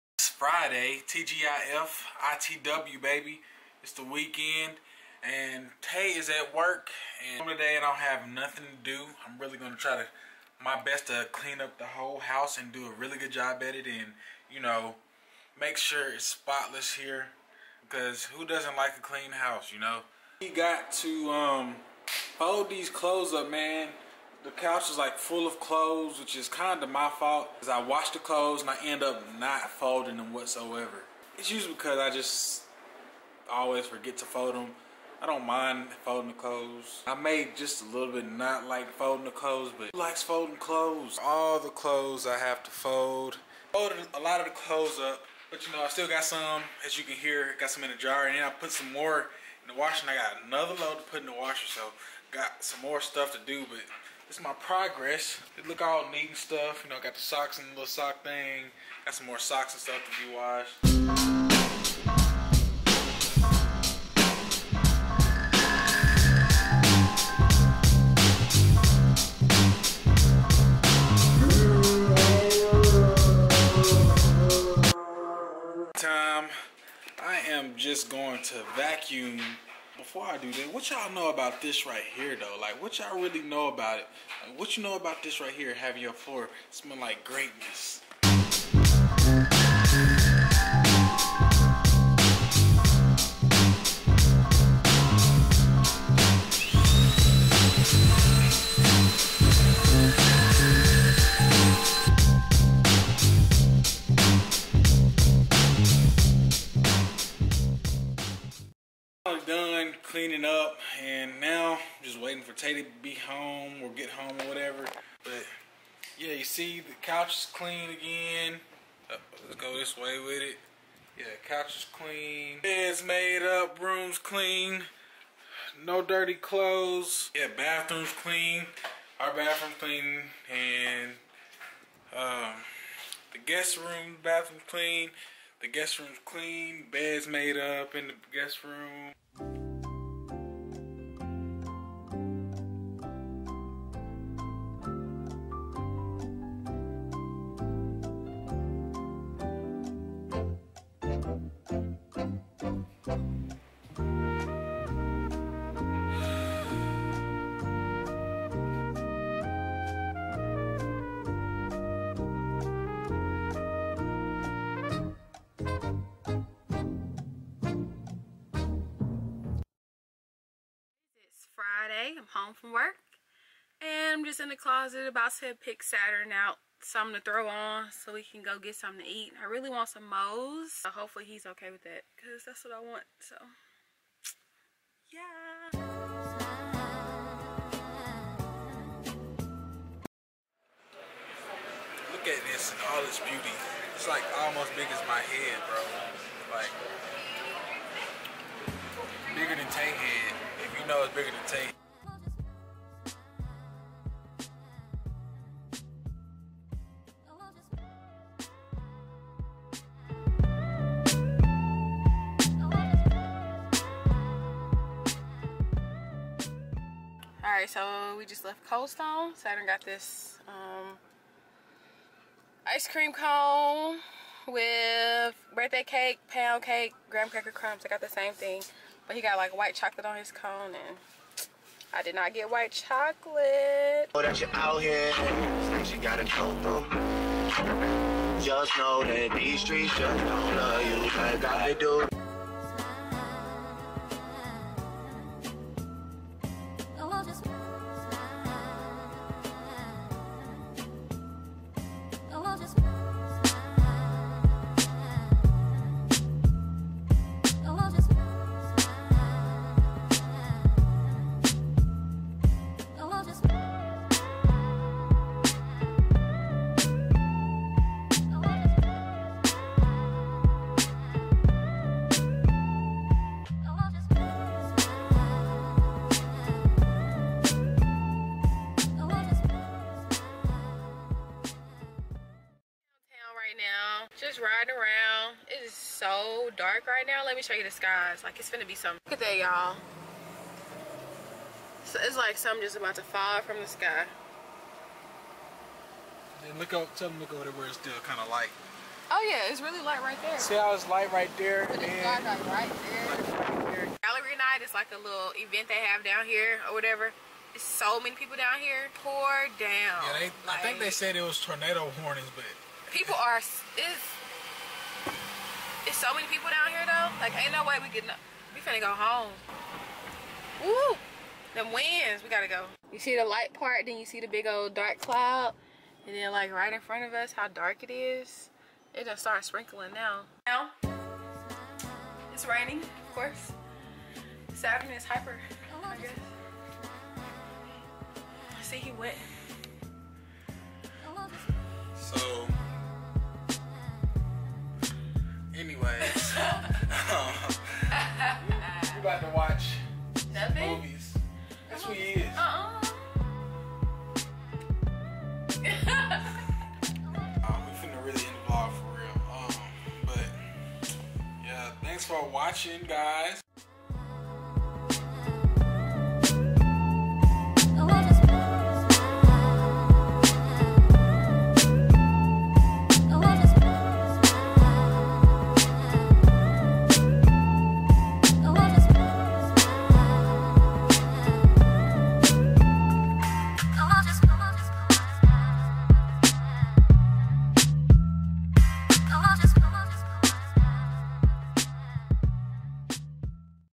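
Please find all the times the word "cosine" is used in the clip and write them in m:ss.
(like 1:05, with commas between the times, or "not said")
not said.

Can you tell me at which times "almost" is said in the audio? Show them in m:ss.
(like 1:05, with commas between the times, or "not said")
3:14.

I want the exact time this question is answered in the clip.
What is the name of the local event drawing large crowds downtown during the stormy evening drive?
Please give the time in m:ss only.
5:04.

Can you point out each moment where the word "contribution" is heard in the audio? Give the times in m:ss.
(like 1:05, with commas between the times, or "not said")
not said.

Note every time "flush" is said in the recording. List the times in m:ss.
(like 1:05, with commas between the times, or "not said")
not said.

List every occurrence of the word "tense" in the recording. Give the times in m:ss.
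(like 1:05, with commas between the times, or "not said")
not said.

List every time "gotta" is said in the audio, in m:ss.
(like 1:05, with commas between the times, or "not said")
3:55, 5:22.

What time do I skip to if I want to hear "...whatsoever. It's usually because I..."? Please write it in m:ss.
0:30.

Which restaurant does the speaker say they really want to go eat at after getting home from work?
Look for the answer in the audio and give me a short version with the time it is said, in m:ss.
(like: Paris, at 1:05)
Moe's, at 3:00.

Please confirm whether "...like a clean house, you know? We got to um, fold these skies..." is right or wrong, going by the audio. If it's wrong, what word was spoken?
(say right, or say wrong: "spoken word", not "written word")
wrong: "clothes", not "skies".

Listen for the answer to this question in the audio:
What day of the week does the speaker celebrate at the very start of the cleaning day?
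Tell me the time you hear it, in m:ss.
0:00.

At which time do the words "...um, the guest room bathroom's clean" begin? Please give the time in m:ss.
2:12.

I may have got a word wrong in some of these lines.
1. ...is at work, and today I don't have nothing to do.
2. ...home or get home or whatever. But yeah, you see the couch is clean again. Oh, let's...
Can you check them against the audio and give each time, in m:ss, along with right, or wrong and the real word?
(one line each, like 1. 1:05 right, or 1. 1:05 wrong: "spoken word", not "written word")
1. 0:06 right
2. 1:53 right.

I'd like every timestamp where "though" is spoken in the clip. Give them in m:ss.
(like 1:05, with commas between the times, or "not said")
1:22, 5:16.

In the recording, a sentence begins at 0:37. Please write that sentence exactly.
I may just a little bit not like folding the clothes, but likes folding clothes.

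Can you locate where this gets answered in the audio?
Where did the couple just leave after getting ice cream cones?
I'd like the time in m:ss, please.
3:38.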